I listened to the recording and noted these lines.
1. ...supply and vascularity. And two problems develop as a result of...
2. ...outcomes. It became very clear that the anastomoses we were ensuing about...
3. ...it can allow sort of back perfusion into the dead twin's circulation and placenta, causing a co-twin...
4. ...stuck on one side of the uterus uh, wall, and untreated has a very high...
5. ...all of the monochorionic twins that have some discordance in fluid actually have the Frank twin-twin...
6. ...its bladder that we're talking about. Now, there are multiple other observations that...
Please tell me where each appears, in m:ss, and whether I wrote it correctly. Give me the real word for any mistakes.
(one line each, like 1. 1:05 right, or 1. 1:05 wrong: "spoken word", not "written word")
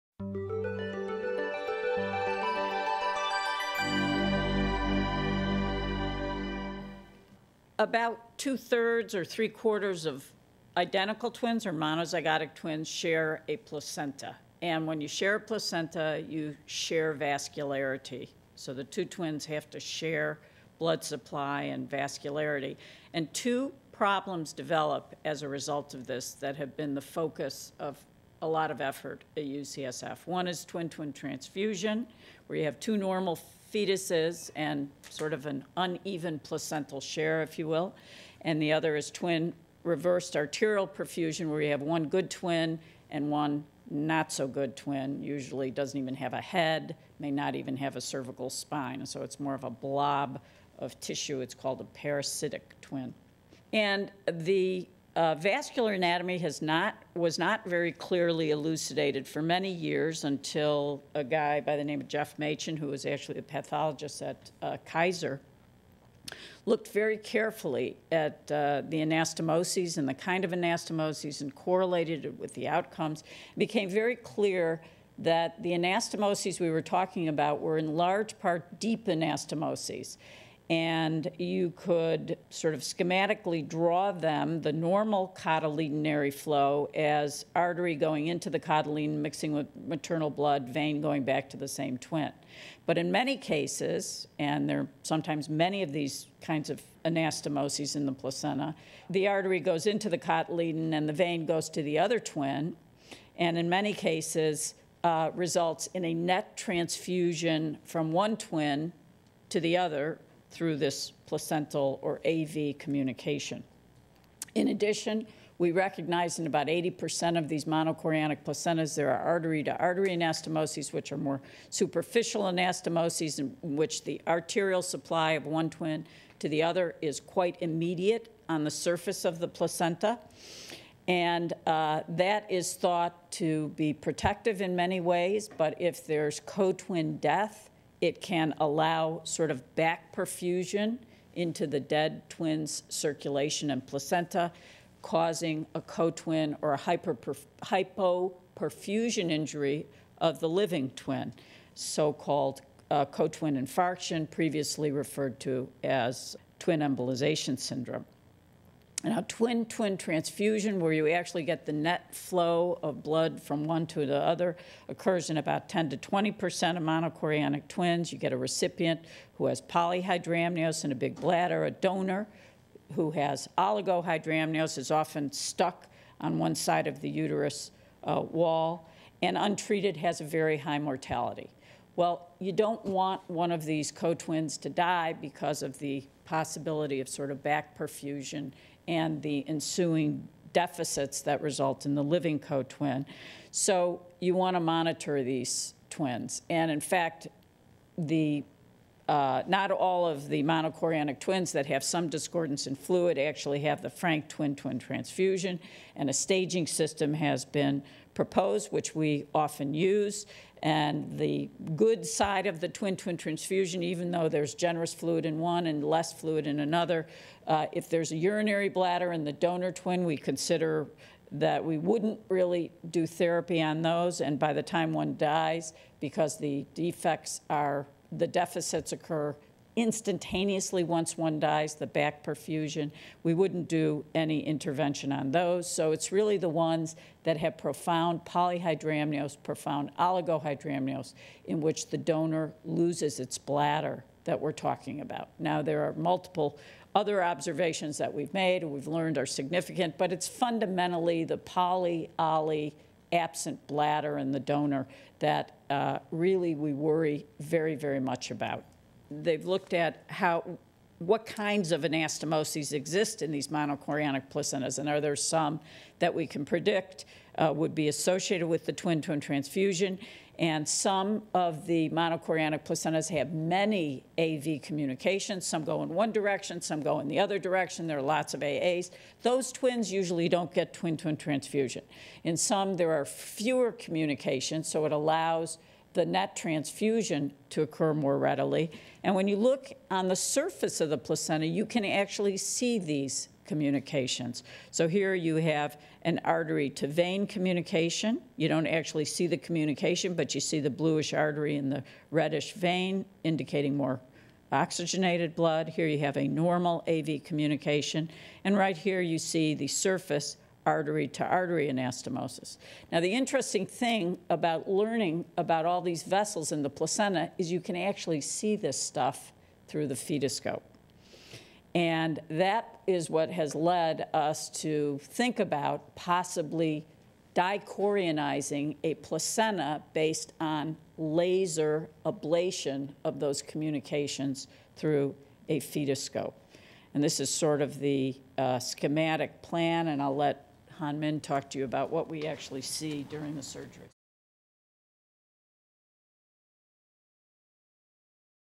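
1. 0:21 right
2. 1:12 wrong: "talking", not "ensuing"
3. 2:18 right
4. 2:55 right
5. 3:19 right
6. 4:03 right.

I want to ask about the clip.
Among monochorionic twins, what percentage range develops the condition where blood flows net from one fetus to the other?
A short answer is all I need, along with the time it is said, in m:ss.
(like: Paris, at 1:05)
10 to 20 percent, at 2:45.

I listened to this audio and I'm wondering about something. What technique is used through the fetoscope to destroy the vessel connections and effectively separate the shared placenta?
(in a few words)
laser ablation.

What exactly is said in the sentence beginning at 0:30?
One is twin twin transfusion, where you have two normal fetuses and sort of an uneven placental share, if you will.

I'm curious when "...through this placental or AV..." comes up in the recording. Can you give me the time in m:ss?
1:50.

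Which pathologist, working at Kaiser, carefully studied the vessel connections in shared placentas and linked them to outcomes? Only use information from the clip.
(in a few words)
Jeff Machin.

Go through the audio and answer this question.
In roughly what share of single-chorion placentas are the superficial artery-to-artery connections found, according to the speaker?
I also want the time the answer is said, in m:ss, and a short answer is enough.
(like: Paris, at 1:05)
80%, at 1:56.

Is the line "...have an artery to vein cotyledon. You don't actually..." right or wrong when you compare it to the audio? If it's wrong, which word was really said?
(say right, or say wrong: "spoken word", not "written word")
wrong: "communication", not "cotyledon".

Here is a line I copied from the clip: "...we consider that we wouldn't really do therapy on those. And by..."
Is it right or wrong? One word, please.
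right.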